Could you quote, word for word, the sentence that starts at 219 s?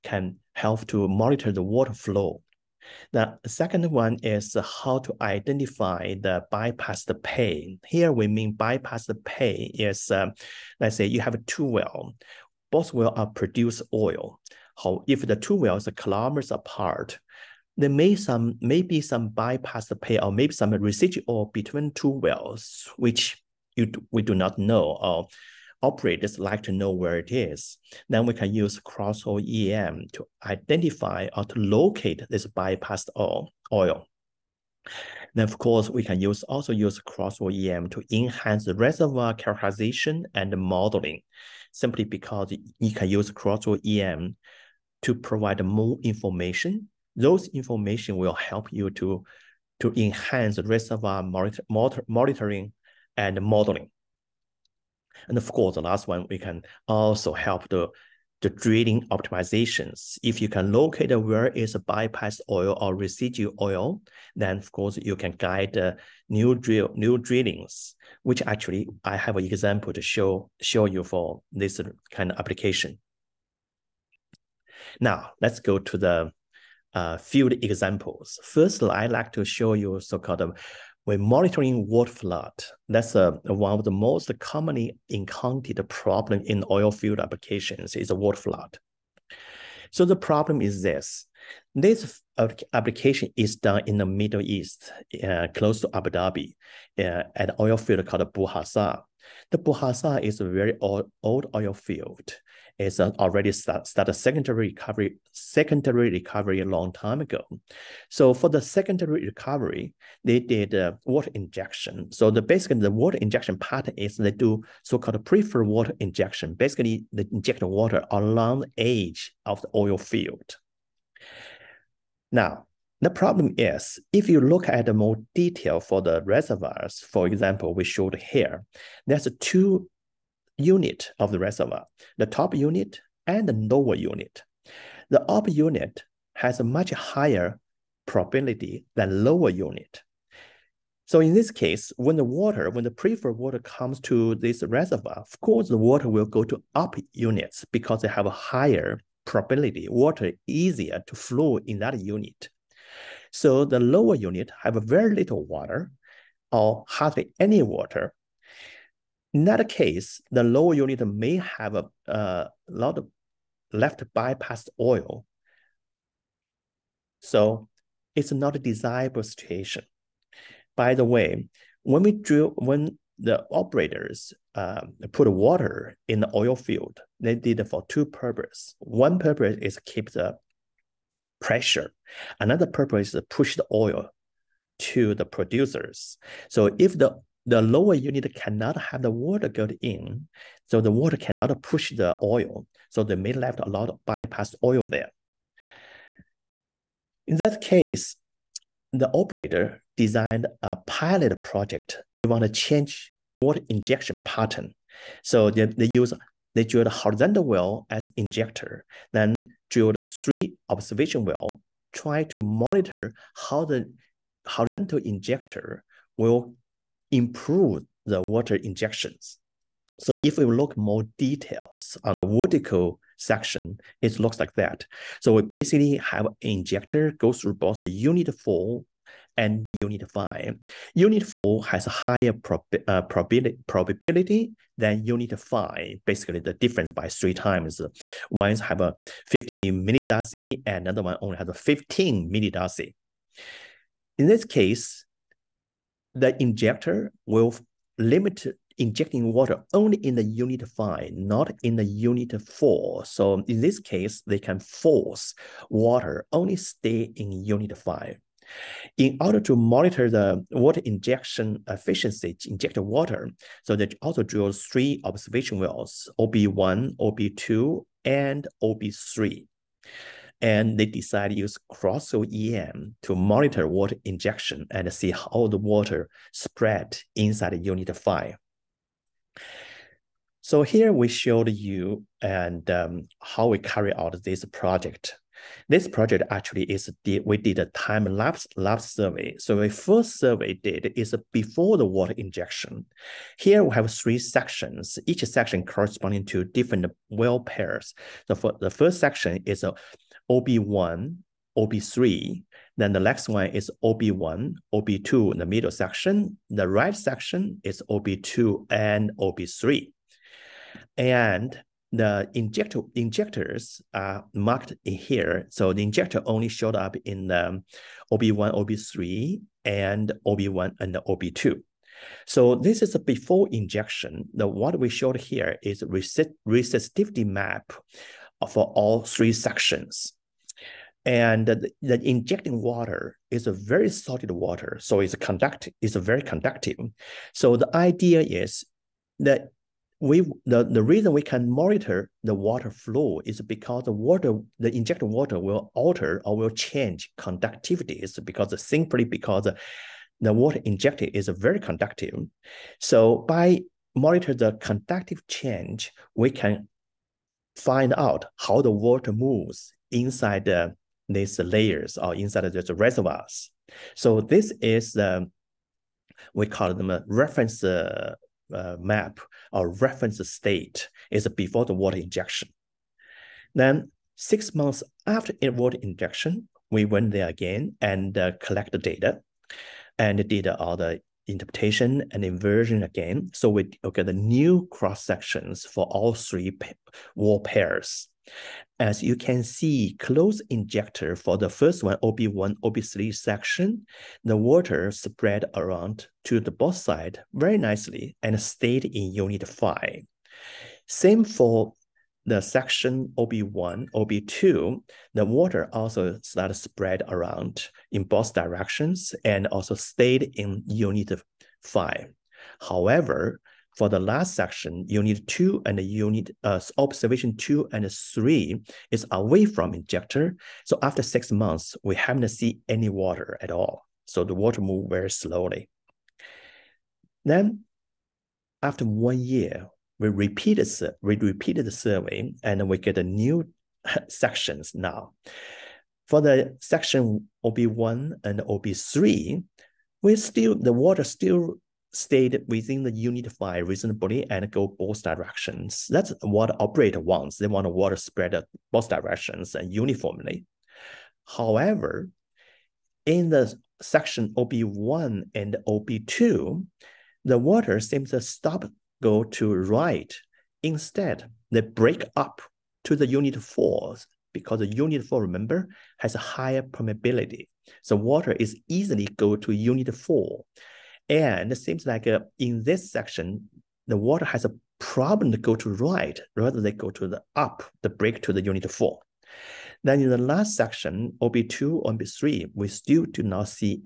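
So if we look more details on the vertical section, it looks like that.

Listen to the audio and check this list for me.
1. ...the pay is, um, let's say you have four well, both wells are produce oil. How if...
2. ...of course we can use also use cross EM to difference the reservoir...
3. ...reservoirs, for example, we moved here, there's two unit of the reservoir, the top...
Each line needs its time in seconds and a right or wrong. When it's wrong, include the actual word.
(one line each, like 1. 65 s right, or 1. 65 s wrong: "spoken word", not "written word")
1. 9 s wrong: "two", not "four"
2. 35 s wrong: "enhance", not "difference"
3. 126 s wrong: "showed", not "moved".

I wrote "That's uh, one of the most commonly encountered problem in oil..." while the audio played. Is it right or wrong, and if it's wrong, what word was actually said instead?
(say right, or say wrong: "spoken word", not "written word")
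right.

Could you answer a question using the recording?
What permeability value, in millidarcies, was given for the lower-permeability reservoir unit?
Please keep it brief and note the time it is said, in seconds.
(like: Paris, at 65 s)
15 millidarcy, at 241 s.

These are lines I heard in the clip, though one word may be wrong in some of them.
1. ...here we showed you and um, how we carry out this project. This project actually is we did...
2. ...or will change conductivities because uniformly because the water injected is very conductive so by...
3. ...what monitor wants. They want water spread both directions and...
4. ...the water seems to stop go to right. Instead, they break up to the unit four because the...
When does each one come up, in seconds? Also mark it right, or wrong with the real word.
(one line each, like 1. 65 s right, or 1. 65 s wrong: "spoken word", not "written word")
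1. 280 s right
2. 346 s wrong: "simply", not "uniformly"
3. 446 s wrong: "operator", not "monitor"
4. 457 s right.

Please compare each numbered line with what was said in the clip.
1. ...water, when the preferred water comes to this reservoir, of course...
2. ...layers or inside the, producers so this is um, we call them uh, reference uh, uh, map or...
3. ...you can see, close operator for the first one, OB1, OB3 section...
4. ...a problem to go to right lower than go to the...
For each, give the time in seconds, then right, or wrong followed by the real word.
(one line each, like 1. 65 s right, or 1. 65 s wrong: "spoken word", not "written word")
1. 142 s right
2. 361 s wrong: "reservoirs", not "producers"
3. 389 s wrong: "injector", not "operator"
4. 474 s wrong: "rather", not "lower".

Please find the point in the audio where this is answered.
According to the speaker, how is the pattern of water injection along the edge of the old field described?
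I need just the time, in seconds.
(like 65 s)
115 s.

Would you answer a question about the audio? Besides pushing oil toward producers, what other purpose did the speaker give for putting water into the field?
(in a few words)
keep the pressure.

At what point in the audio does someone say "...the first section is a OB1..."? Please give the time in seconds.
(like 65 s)
298 s.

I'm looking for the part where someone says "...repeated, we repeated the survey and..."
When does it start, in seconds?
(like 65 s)
430 s.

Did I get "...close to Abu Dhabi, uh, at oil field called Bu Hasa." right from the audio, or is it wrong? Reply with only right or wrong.
right.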